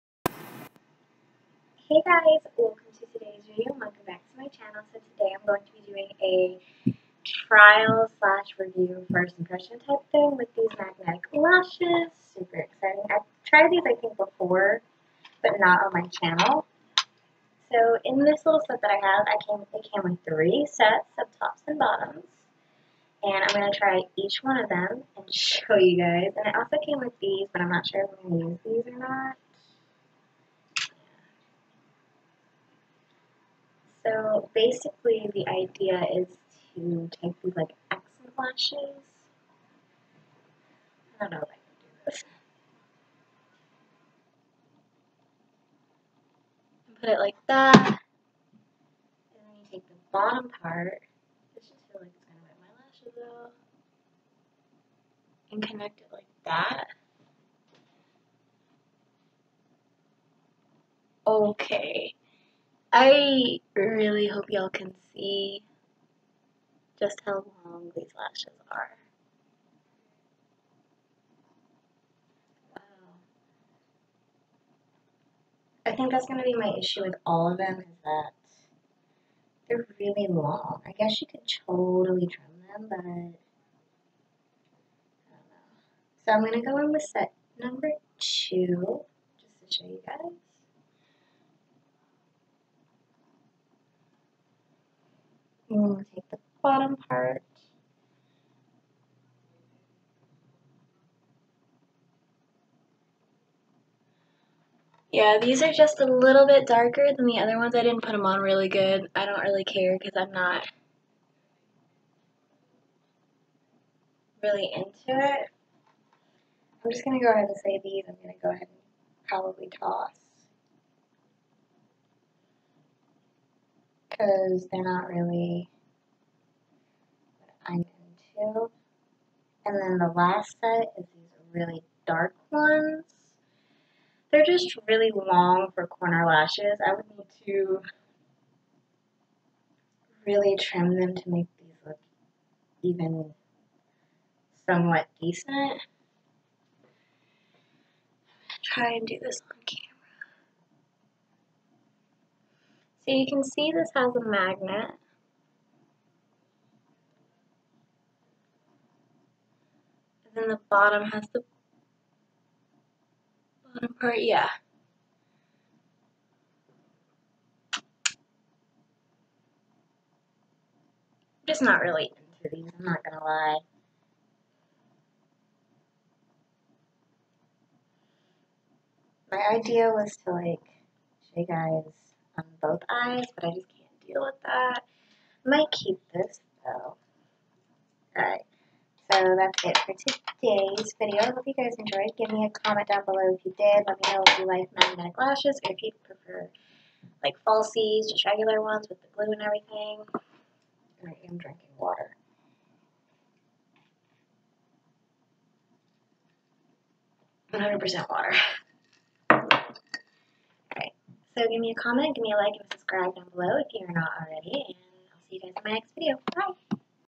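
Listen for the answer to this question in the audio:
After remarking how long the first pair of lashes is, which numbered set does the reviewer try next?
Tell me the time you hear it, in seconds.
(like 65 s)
87 s.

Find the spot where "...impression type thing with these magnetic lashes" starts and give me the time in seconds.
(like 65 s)
9 s.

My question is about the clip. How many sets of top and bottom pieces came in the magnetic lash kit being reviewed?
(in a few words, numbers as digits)
3.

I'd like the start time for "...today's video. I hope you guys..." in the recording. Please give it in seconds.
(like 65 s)
189 s.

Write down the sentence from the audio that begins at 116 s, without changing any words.
I'm just going to go ahead and say these.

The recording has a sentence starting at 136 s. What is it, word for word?
I would need to really trim them to make these look even somewhat decent.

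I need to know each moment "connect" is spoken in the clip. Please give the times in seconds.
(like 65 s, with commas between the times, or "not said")
55 s.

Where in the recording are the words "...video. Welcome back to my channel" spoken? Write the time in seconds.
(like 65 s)
3 s.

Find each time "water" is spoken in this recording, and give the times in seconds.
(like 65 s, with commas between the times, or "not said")
201 s, 208 s.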